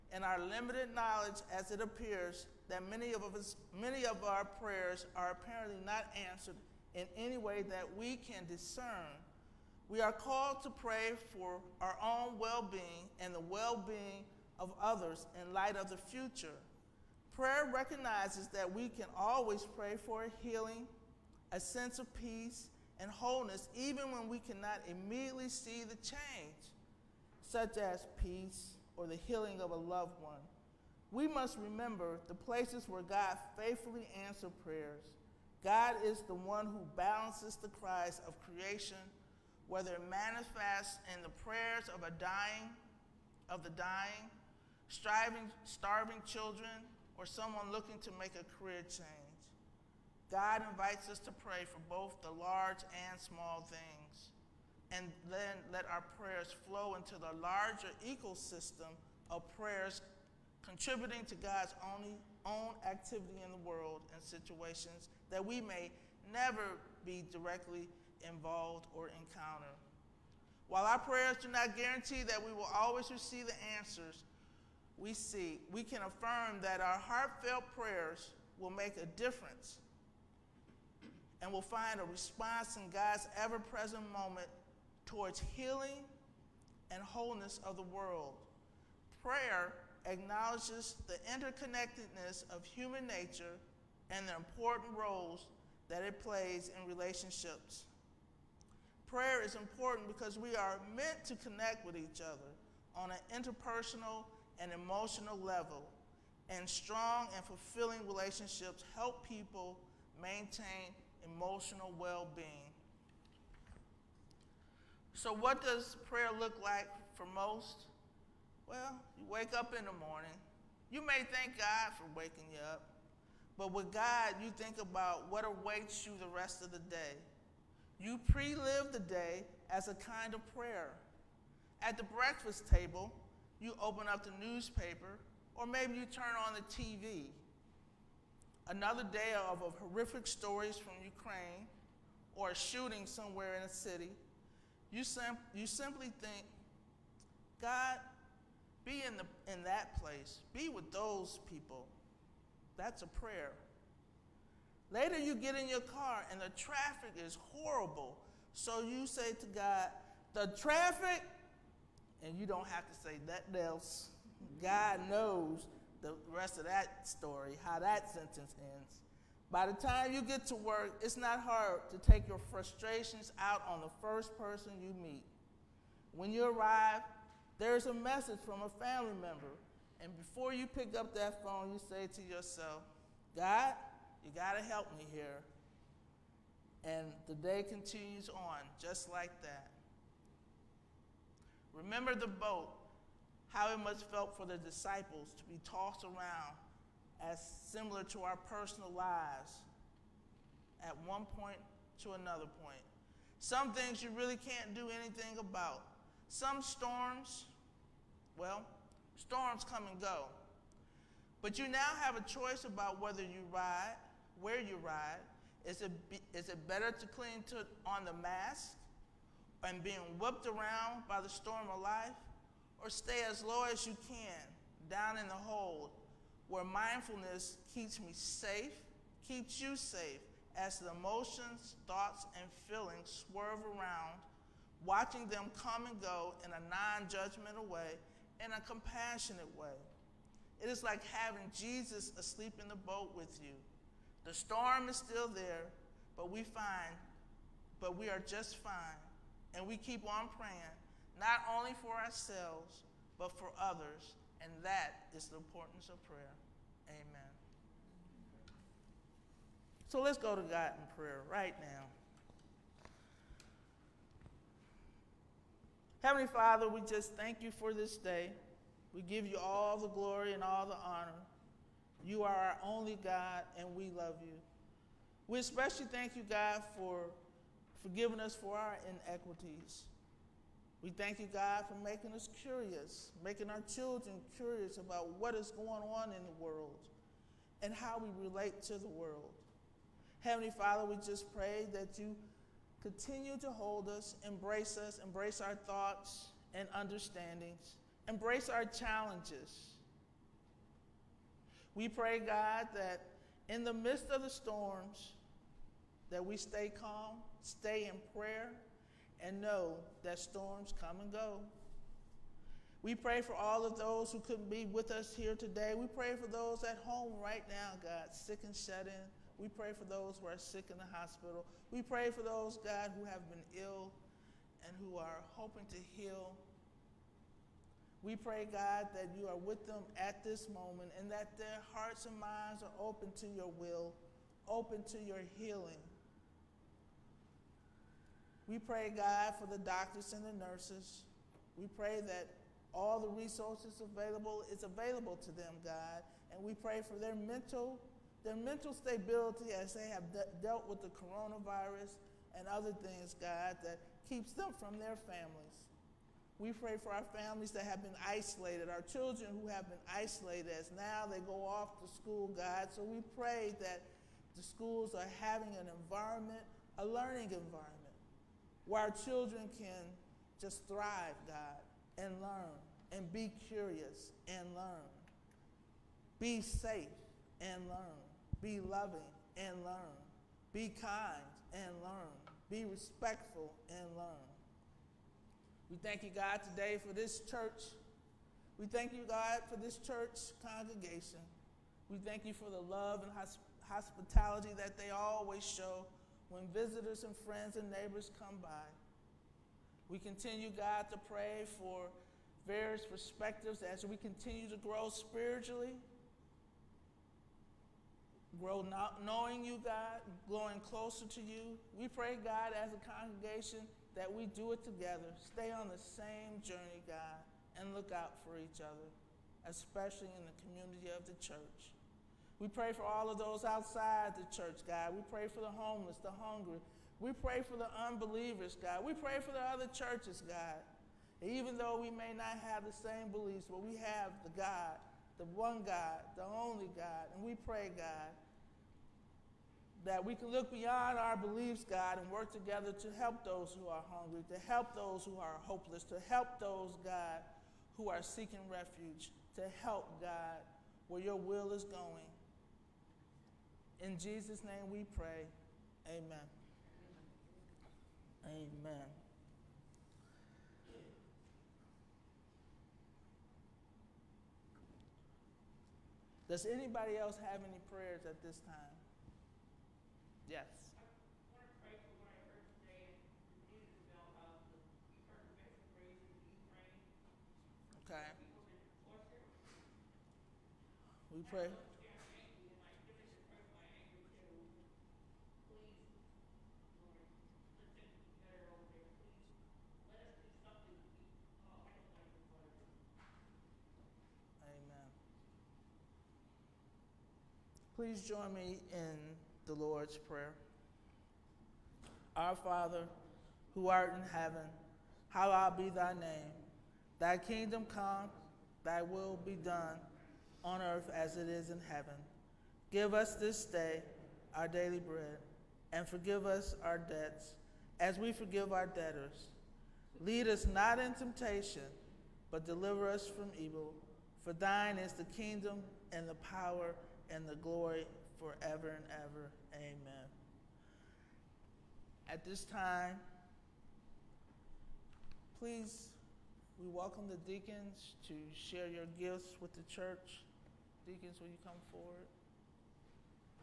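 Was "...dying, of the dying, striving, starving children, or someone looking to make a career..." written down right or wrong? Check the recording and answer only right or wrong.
right.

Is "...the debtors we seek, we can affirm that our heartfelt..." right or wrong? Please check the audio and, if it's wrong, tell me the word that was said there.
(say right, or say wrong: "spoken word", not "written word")
wrong: "answers", not "debtors".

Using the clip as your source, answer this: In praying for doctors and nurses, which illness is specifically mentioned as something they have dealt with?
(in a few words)
Coronavirus.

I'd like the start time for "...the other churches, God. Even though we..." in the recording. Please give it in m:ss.
7:09.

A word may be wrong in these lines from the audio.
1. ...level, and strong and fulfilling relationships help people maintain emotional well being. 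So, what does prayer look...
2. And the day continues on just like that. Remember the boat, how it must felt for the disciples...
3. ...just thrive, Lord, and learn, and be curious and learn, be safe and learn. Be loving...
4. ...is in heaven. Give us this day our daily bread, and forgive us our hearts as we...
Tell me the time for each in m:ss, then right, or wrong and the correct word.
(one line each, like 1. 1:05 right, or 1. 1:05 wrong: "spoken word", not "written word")
1. 1:45 right
2. 3:06 right
3. 6:10 wrong: "God", not "Lord"
4. 8:31 wrong: "debts", not "hearts".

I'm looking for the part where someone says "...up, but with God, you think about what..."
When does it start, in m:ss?
2:02.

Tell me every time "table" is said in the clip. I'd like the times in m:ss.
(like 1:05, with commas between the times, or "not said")
2:12.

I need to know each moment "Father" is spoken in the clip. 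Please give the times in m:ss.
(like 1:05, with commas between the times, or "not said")
4:26, 4:50, 8:22.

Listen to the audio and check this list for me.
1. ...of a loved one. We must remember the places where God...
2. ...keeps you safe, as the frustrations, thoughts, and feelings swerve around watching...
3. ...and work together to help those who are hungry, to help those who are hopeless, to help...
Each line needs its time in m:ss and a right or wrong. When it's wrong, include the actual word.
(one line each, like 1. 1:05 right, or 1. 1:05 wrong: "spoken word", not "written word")
1. 0:29 right
2. 3:49 wrong: "emotions", not "frustrations"
3. 7:22 right.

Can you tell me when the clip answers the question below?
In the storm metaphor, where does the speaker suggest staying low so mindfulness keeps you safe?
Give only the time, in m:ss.
3:44.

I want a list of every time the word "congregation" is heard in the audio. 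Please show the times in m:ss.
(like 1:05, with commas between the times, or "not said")
6:30, 6:52.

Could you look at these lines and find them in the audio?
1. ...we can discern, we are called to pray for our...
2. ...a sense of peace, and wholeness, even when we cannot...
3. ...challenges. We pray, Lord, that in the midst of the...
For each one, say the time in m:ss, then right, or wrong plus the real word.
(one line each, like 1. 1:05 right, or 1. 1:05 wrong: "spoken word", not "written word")
1. 0:07 right
2. 0:21 right
3. 4:58 wrong: "God", not "Lord".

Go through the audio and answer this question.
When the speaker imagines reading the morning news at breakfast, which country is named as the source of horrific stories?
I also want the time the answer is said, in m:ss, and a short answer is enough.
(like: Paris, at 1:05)
Ukraine, at 2:21.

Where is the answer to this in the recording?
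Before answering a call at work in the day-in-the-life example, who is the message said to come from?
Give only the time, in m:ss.
2:58.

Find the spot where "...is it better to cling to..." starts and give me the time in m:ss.
3:36.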